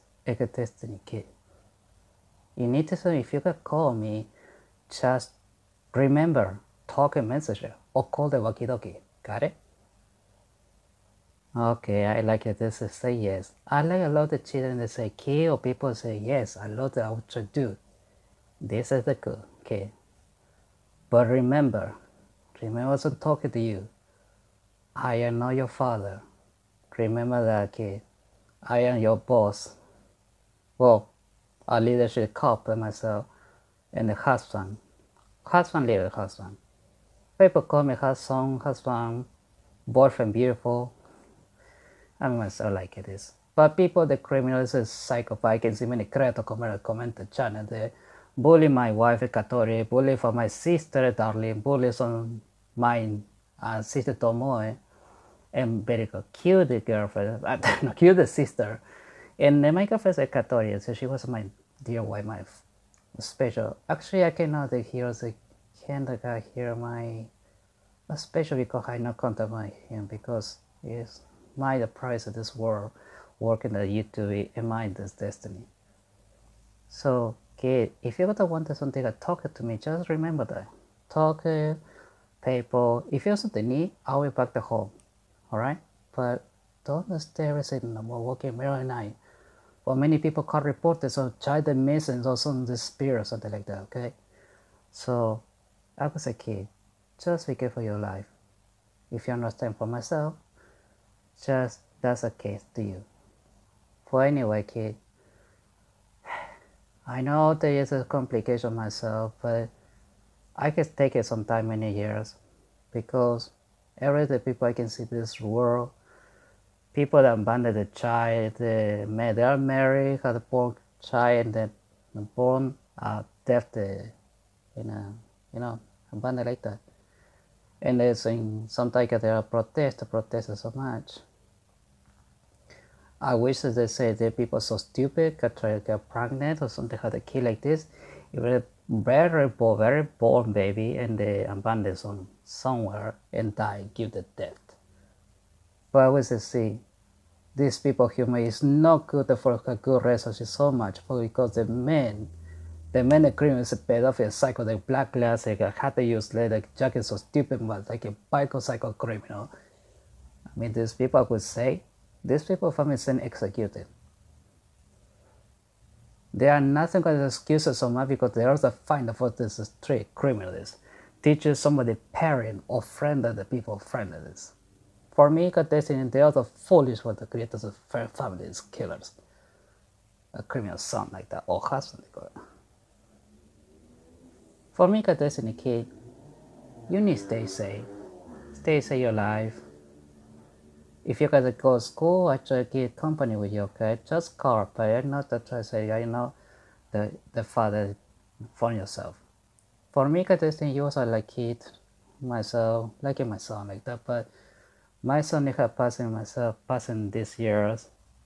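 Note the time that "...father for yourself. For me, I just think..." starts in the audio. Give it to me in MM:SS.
03:17.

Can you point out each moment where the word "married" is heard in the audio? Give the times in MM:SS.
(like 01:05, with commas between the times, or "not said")
01:59.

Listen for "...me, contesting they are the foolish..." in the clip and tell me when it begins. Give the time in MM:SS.
02:55.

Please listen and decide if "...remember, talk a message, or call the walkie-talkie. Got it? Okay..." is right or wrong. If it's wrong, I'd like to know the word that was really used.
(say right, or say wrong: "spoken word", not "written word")
right.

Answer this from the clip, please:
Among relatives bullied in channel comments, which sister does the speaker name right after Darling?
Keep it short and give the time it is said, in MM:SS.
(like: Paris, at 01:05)
Tomoe, at 00:54.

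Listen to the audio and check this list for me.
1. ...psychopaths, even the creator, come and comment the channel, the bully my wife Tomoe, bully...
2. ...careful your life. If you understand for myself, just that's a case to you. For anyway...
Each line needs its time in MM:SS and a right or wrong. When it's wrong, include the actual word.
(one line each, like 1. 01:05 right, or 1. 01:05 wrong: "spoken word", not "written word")
1. 00:44 wrong: "Katori", not "Tomoe"
2. 01:37 right.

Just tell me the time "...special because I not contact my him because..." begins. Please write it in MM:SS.
01:08.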